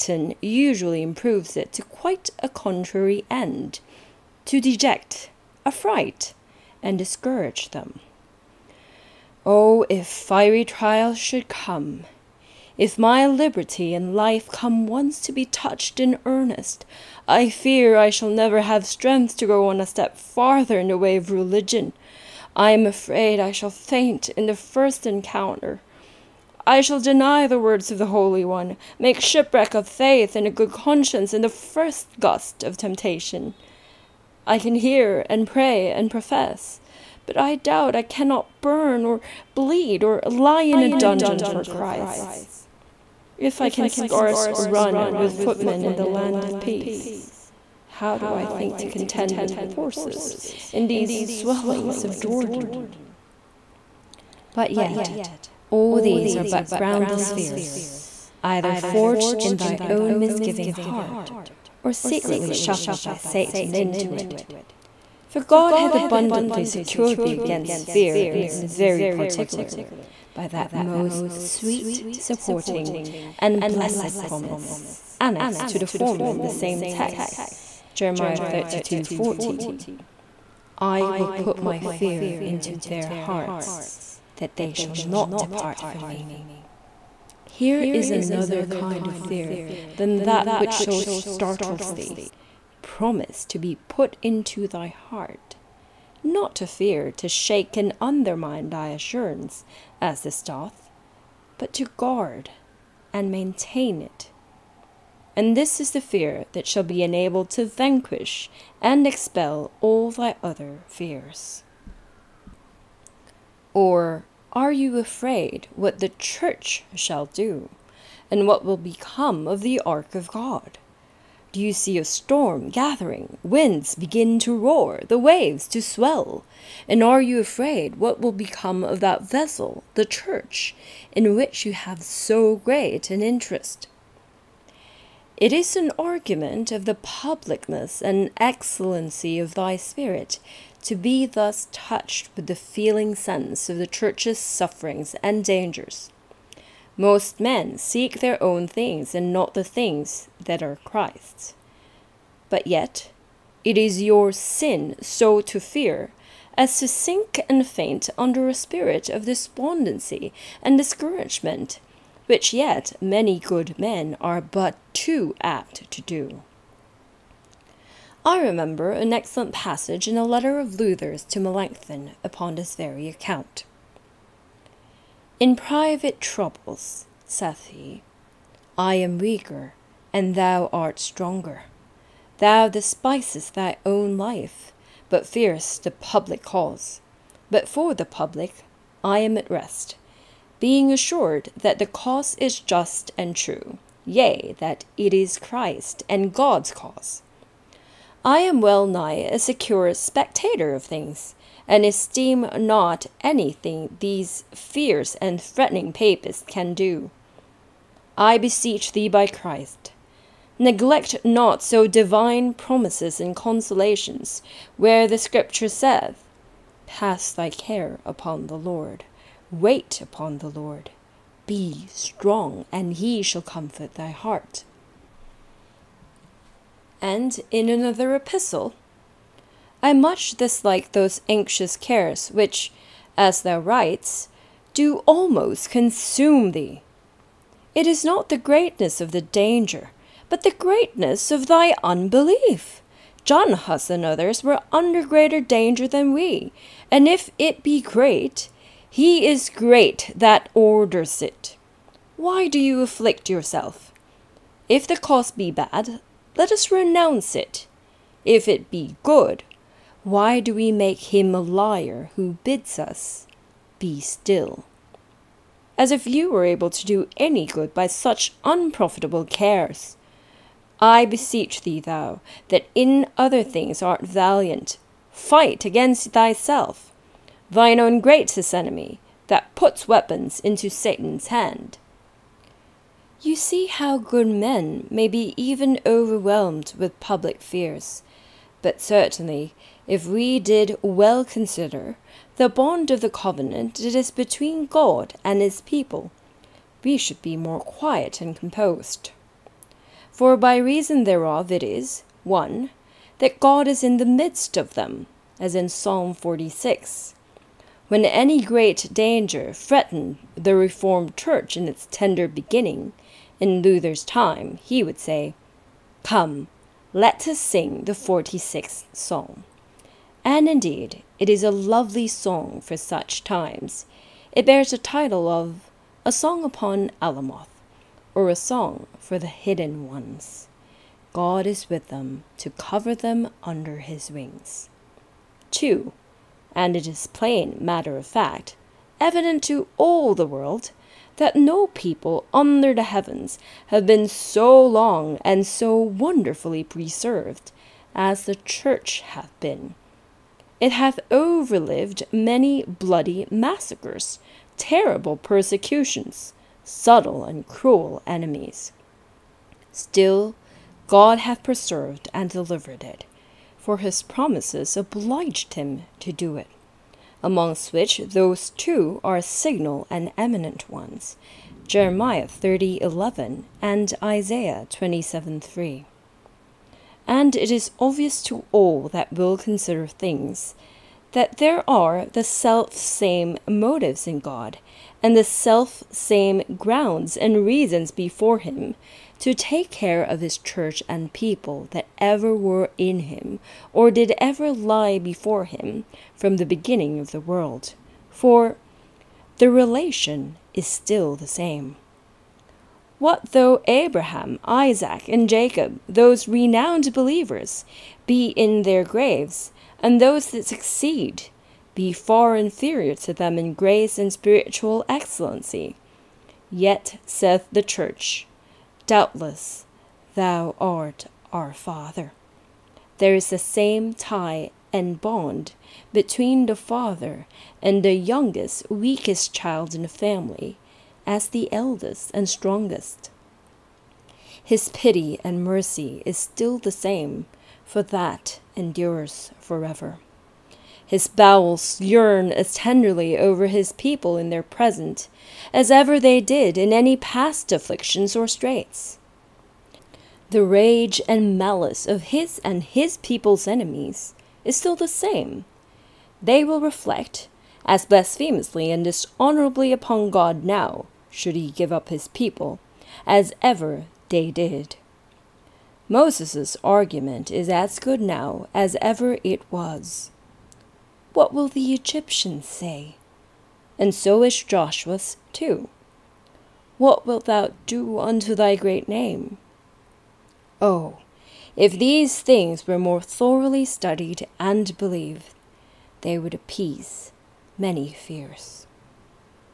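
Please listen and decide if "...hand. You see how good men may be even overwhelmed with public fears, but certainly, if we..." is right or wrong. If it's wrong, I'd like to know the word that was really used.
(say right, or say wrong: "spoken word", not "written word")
right.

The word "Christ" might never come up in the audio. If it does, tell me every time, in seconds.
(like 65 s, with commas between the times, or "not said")
41 s, 150 s, 195 s, 209 s.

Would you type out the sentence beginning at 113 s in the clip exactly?
Or are you afraid what the church shall do, and what will become of the ark of God?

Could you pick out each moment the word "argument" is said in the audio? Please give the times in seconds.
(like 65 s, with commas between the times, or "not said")
135 s, 466 s.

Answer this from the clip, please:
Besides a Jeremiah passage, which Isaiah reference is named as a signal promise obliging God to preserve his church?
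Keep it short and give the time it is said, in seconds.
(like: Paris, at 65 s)
Isaiah 27:3, at 374 s.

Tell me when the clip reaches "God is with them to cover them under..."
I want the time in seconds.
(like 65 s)
331 s.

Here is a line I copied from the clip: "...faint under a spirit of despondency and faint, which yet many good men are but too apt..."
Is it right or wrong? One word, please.
wrong.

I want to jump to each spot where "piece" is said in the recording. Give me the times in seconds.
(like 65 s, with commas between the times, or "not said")
not said.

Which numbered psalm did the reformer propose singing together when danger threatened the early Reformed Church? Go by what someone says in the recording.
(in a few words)
46th Psalm.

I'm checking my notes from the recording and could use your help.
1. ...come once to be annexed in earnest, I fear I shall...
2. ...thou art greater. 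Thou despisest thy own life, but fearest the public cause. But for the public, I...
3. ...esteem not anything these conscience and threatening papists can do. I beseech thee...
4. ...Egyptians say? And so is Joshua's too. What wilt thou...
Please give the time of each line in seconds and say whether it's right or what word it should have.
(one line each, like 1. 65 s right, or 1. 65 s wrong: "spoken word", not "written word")
1. 14 s wrong: "touched", not "annexed"
2. 180 s wrong: "stronger", not "greater"
3. 201 s wrong: "fierce", not "conscience"
4. 471 s right.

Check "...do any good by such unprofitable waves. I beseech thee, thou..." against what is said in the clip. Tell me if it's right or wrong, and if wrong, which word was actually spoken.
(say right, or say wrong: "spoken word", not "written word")
wrong: "cares", not "waves".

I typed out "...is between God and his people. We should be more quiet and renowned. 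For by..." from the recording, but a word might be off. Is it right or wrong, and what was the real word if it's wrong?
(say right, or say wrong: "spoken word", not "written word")
wrong: "composed", not "renowned".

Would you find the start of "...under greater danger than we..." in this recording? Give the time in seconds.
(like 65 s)
244 s.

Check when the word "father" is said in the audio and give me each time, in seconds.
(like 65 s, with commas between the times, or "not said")
421 s, 426 s.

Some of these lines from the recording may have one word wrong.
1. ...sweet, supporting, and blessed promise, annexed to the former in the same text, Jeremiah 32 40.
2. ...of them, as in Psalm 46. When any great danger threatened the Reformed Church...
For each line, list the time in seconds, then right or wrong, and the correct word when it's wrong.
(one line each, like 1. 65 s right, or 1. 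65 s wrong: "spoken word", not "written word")
1. 71 s right
2. 304 s right.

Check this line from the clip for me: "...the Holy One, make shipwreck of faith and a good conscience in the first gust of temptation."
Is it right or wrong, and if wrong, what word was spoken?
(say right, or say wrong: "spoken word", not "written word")
right.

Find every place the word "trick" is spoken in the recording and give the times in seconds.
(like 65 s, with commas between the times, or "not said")
not said.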